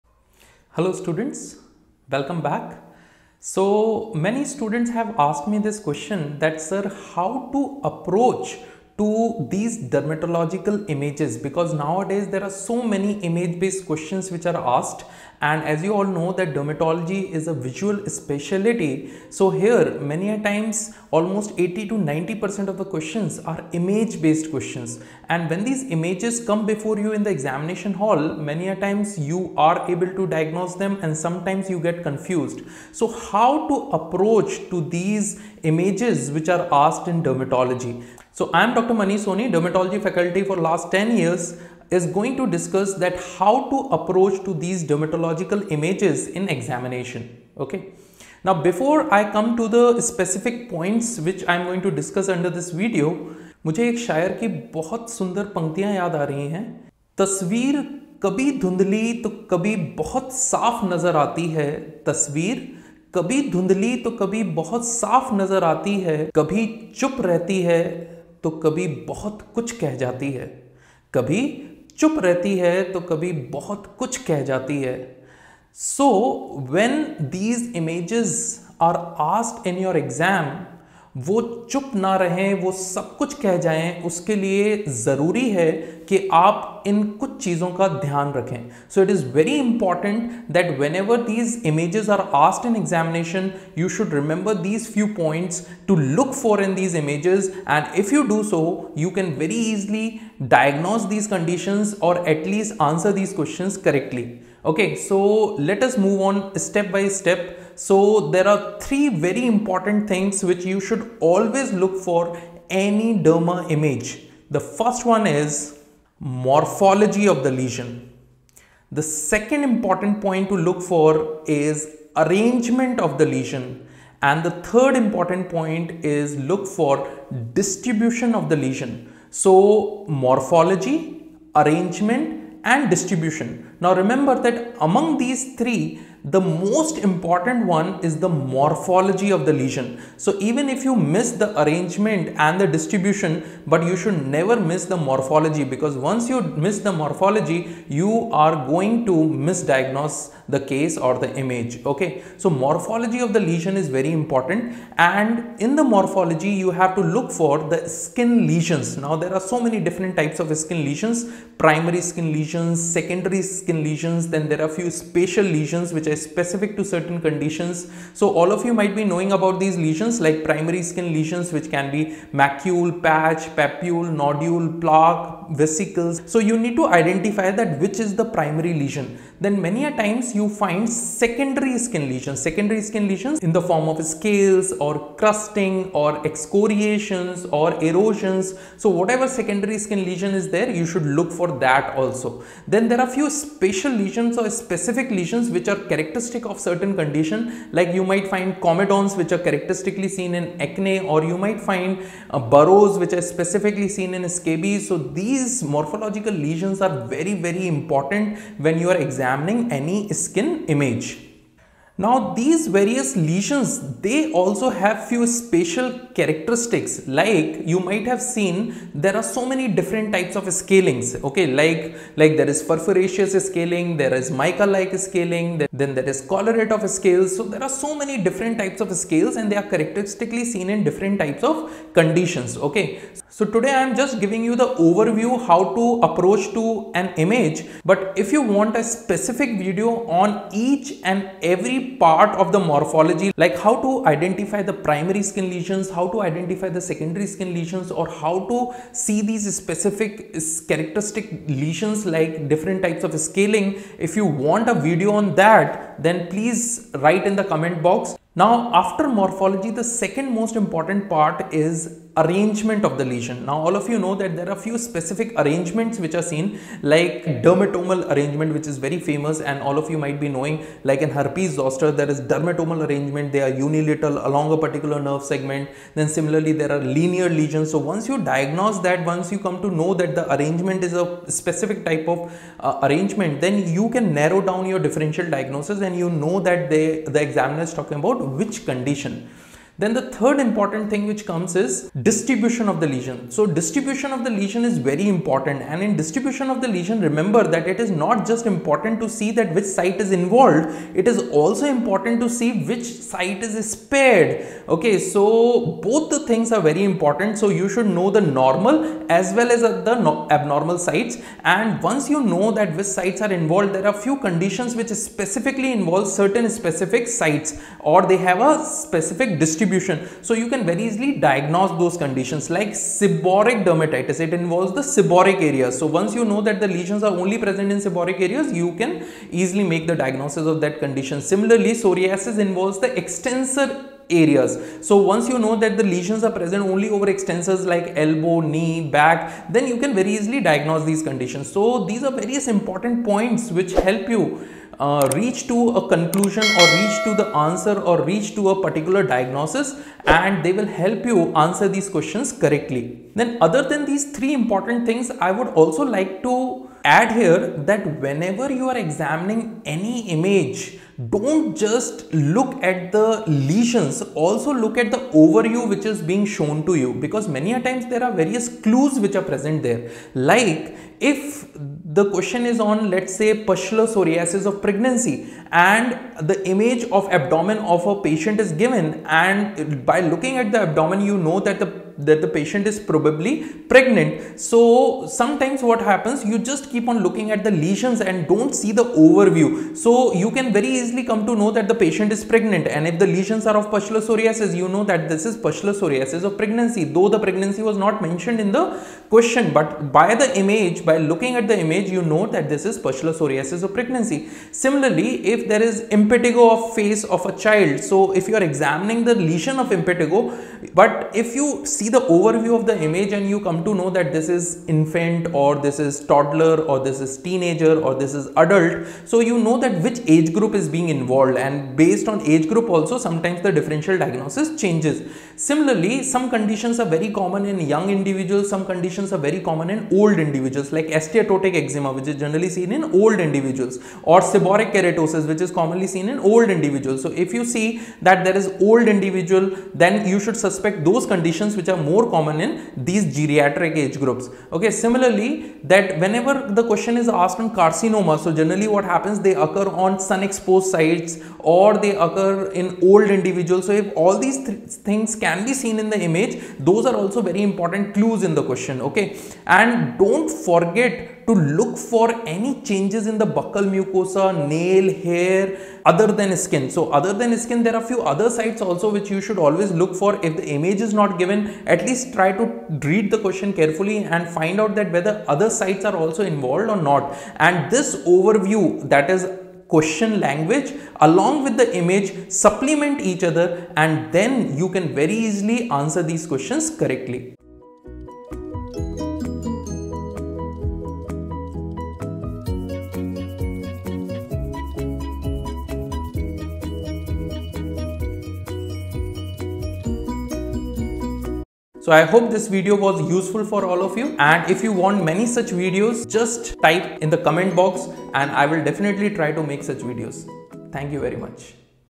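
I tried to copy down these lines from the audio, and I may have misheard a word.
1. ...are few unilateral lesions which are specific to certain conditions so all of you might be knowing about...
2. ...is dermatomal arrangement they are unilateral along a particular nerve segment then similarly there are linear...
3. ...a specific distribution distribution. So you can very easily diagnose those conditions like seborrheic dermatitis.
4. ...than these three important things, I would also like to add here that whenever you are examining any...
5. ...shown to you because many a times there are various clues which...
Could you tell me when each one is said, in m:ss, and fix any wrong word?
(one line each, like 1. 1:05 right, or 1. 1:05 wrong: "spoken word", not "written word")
1. 2:44 wrong: "spatial", not "unilateral"
2. 4:32 right
3. 5:18 right
4. 5:53 right
5. 6:06 right.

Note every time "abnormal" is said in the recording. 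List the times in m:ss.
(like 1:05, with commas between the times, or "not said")
5:10.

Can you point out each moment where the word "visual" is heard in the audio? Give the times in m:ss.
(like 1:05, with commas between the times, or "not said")
0:17.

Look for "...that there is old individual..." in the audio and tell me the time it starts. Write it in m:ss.
7:18.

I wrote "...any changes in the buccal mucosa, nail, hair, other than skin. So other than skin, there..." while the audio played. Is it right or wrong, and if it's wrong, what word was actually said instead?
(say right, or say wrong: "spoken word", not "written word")
right.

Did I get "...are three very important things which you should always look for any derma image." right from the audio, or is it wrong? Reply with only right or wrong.
right.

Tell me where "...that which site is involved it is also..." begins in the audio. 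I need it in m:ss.
4:59.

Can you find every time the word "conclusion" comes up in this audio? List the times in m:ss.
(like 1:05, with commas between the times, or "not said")
5:45.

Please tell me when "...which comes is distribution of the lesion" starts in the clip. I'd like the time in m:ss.
4:51.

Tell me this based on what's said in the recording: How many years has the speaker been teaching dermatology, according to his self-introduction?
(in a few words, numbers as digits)
10.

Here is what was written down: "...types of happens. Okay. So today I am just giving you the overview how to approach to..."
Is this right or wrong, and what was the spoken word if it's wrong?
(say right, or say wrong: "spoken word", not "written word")
wrong: "conditions", not "happens".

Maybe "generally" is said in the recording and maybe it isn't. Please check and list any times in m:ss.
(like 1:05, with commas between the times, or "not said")
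7:12, 7:28.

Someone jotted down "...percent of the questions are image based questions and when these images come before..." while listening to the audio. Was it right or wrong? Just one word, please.
right.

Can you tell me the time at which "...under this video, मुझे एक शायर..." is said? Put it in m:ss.
0:52.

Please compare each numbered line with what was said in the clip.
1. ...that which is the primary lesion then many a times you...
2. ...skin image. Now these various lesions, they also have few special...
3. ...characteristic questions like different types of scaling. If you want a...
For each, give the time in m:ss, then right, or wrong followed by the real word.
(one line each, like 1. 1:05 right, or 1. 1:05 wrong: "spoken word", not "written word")
1. 2:57 right
2. 3:30 right
3. 4:10 wrong: "lesions", not "questions".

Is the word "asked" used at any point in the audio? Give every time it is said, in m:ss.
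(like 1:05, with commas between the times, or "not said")
0:05, 0:14, 0:36, 7:27.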